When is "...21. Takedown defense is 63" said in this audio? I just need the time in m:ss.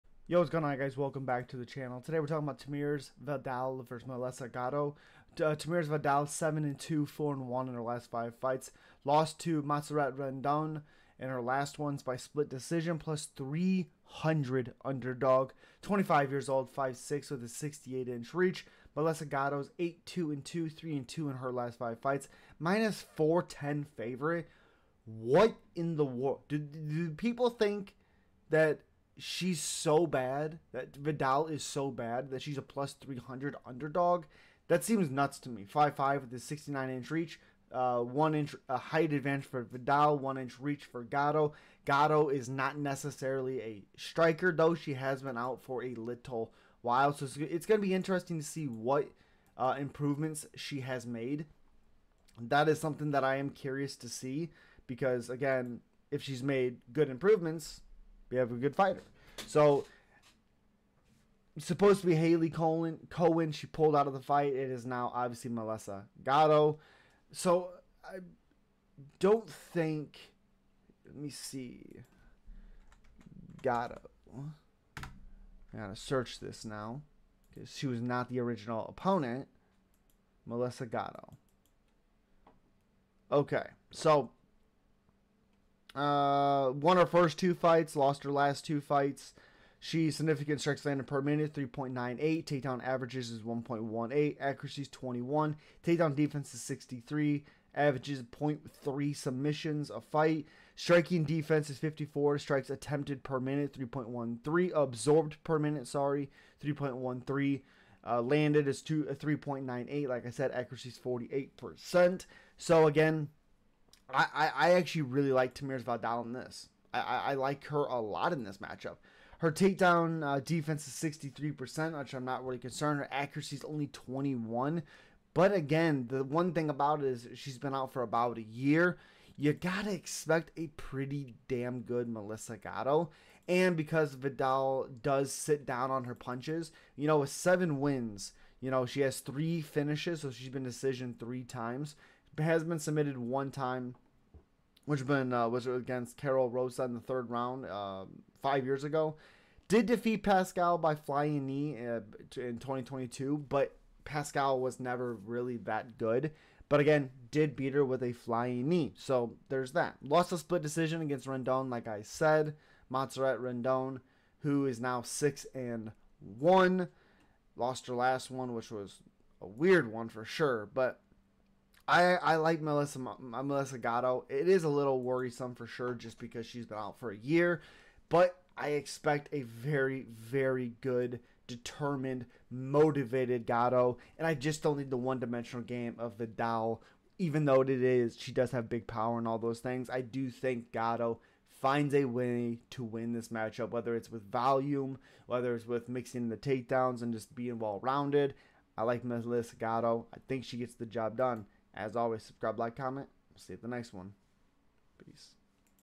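1:34.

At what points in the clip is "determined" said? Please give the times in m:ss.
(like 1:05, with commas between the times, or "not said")
3:01.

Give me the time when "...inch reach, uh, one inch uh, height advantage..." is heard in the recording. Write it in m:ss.
0:36.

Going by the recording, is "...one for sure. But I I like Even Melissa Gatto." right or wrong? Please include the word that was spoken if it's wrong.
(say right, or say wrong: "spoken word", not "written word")
wrong: "Melissa", not "Even".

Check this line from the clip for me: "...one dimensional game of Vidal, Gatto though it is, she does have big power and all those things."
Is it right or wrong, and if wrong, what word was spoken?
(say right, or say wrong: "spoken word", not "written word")
wrong: "Even", not "Gatto".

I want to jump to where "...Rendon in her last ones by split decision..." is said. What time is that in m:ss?
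0:10.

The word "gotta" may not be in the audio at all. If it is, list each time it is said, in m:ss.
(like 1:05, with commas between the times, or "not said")
1:15, 2:09.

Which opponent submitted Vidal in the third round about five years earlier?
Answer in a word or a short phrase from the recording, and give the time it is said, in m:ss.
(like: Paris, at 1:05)
Karol Rosa, at 2:26.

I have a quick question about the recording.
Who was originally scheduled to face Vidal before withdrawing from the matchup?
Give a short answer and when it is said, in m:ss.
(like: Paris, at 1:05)
Hailey Cowan, at 1:02.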